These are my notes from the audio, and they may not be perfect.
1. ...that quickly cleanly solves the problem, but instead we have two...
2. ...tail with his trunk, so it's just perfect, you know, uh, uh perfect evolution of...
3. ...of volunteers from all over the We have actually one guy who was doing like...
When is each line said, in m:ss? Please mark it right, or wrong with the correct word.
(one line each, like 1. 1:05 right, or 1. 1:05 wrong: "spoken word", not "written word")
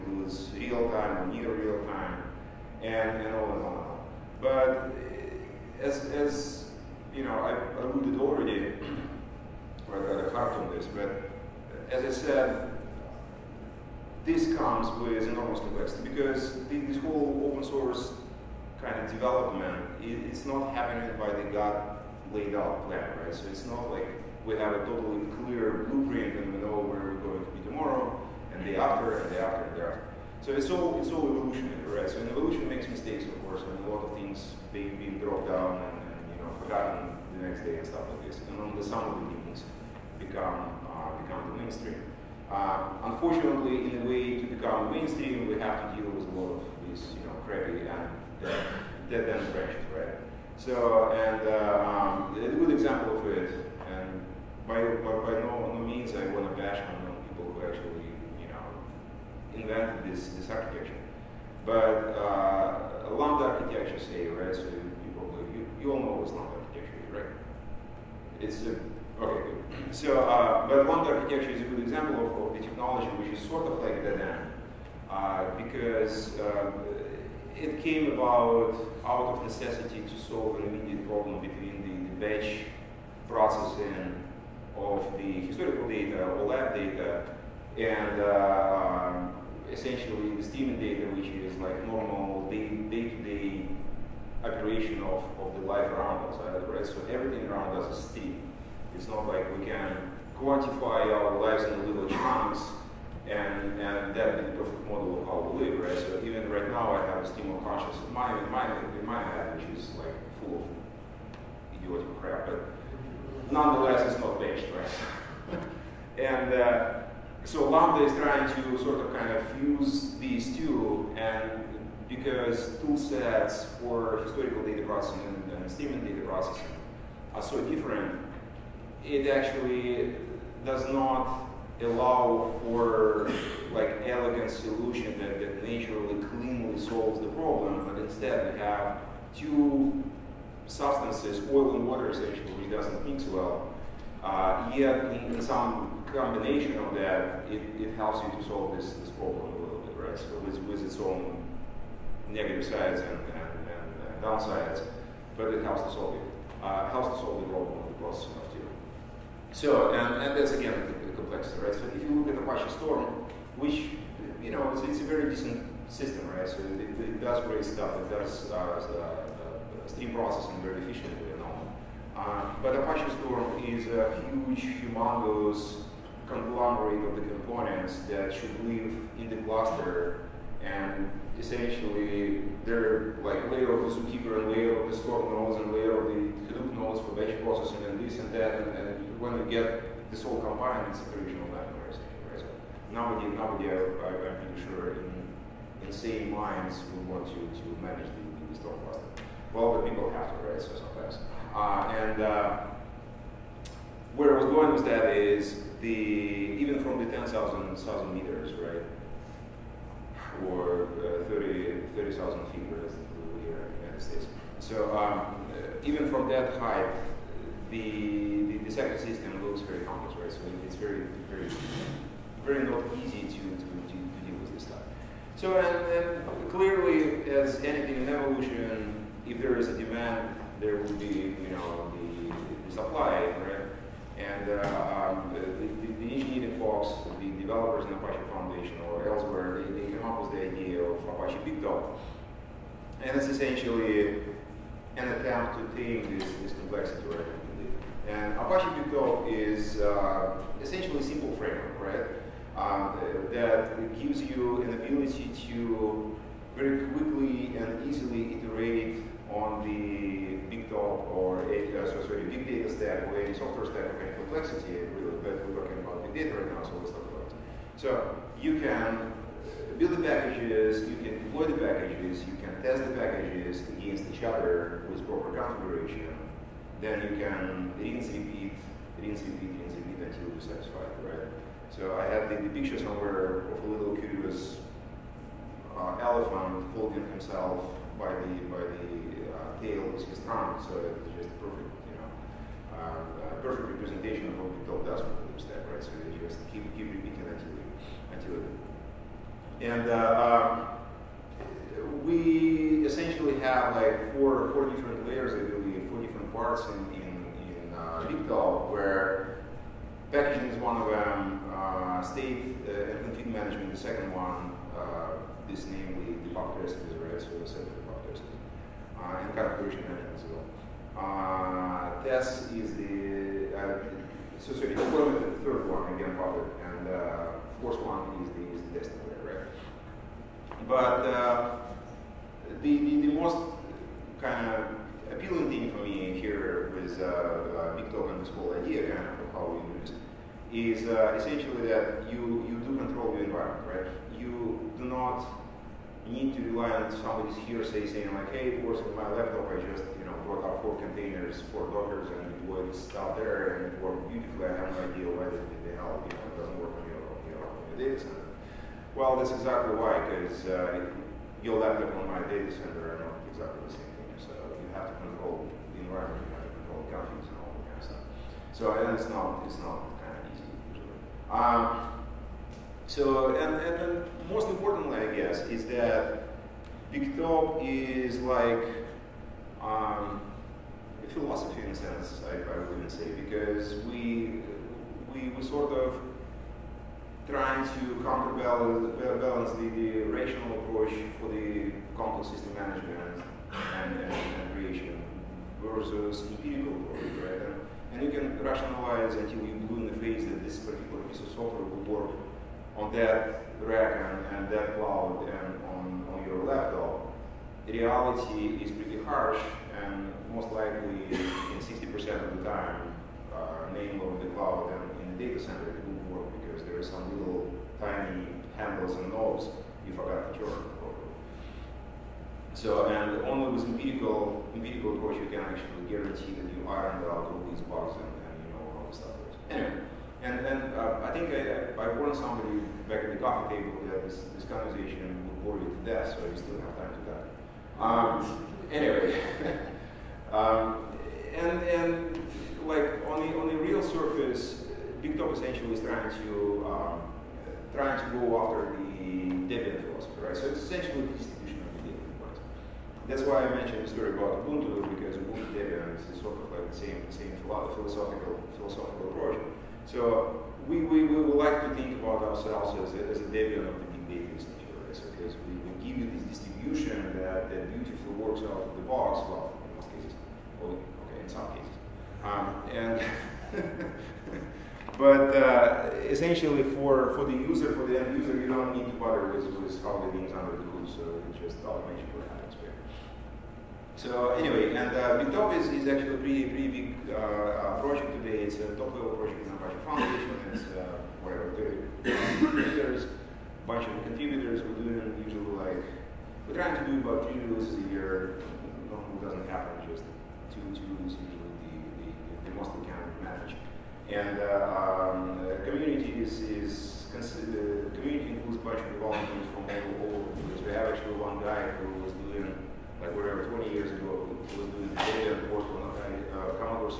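1. 2:15 wrong: "naturally", not "quickly"
2. 4:49 wrong: "representation", not "evolution"
3. 8:28 right.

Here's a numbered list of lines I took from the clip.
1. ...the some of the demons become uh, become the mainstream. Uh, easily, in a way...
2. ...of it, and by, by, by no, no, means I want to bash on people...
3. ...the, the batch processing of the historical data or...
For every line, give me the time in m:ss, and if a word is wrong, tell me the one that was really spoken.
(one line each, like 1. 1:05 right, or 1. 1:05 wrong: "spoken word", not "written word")
1. 0:38 wrong: "unfortunately", not "easily"
2. 0:53 right
3. 1:21 right.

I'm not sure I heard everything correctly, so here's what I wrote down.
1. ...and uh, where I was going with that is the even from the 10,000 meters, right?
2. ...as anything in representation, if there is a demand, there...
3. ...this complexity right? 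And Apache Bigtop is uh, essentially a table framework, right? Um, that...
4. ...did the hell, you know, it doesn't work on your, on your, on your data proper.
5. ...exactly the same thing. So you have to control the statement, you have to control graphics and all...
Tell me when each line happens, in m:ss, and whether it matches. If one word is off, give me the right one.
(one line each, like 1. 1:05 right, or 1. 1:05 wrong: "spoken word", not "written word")
1. 3:21 right
2. 3:47 wrong: "evolution", not "representation"
3. 4:06 wrong: "simple", not "table"
4. 5:55 wrong: "center", not "proper"
5. 6:03 wrong: "environment", not "statement".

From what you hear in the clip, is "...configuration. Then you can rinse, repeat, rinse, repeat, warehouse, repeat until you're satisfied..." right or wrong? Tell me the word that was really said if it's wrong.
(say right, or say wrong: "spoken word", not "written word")
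wrong: "rinse", not "warehouse".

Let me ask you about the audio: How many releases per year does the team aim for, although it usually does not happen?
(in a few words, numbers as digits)
3.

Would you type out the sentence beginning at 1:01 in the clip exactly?
But uh, lambda architecture, say, right?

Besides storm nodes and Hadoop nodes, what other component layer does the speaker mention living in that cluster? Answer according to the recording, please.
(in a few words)
ZooKeeper.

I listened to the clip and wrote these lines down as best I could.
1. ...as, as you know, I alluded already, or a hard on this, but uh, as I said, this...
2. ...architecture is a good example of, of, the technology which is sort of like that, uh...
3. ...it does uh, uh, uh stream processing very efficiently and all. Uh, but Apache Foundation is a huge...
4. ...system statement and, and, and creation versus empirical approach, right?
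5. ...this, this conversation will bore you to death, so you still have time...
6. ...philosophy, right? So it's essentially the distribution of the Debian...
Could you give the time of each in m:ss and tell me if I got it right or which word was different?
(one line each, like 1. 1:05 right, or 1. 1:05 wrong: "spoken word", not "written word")
1. 0:05 right
2. 1:10 right
3. 2:47 wrong: "Storm", not "Foundation"
4. 6:32 wrong: "management", not "statement"
5. 7:14 right
6. 7:29 right.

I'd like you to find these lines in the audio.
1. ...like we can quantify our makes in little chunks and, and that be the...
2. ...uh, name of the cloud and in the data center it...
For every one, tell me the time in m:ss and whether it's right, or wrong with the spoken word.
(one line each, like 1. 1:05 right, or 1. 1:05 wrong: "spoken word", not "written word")
1. 1:39 wrong: "lives", not "makes"
2. 6:53 right.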